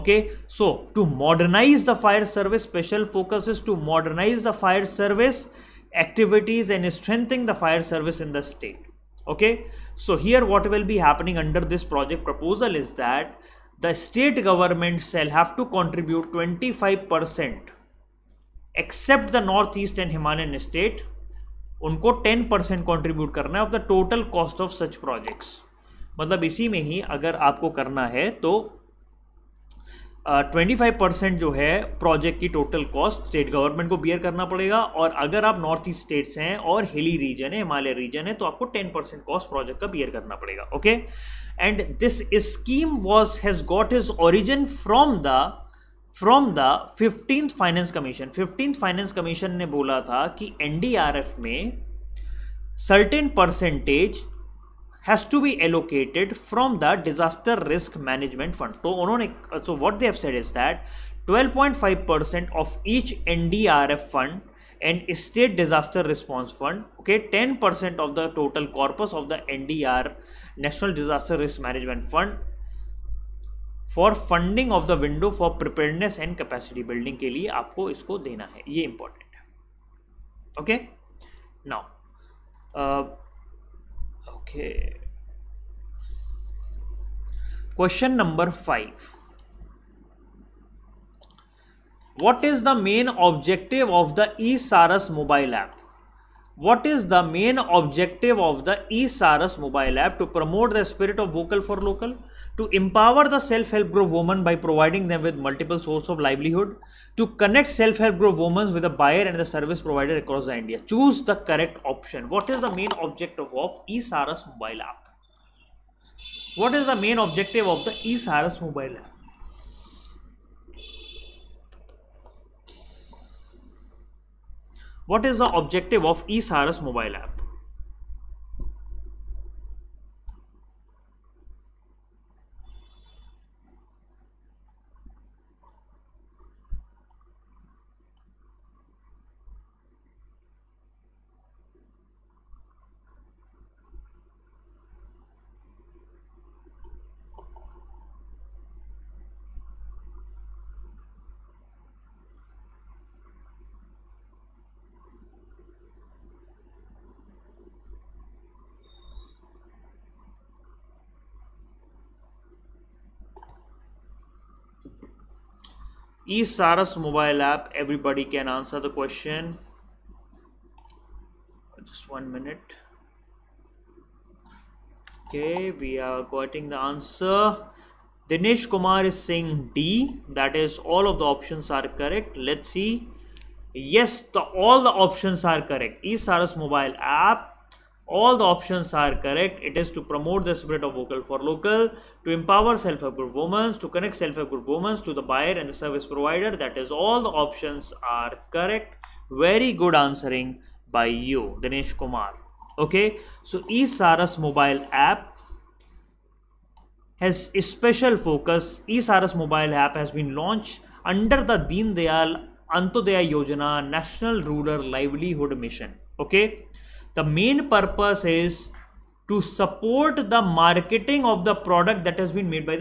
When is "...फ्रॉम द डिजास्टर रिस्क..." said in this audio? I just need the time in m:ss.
0:56.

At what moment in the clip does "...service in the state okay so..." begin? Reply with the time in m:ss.
0:07.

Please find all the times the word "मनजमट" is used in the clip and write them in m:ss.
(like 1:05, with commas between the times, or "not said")
0:58, 1:11.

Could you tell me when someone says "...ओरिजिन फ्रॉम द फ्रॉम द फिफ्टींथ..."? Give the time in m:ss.
0:44.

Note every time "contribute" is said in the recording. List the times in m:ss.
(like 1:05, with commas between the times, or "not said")
0:15.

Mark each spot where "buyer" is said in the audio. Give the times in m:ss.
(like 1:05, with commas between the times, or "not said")
1:49, 3:15.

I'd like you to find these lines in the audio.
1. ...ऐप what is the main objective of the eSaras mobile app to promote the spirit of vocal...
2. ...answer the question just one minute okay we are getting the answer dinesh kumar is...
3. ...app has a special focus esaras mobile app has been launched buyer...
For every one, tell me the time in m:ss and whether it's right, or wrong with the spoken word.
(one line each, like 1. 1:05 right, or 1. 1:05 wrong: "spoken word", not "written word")
1. 1:35 right
2. 2:48 right
3. 3:25 wrong: "under", not "buyer".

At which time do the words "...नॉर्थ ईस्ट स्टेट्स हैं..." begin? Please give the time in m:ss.
0:35.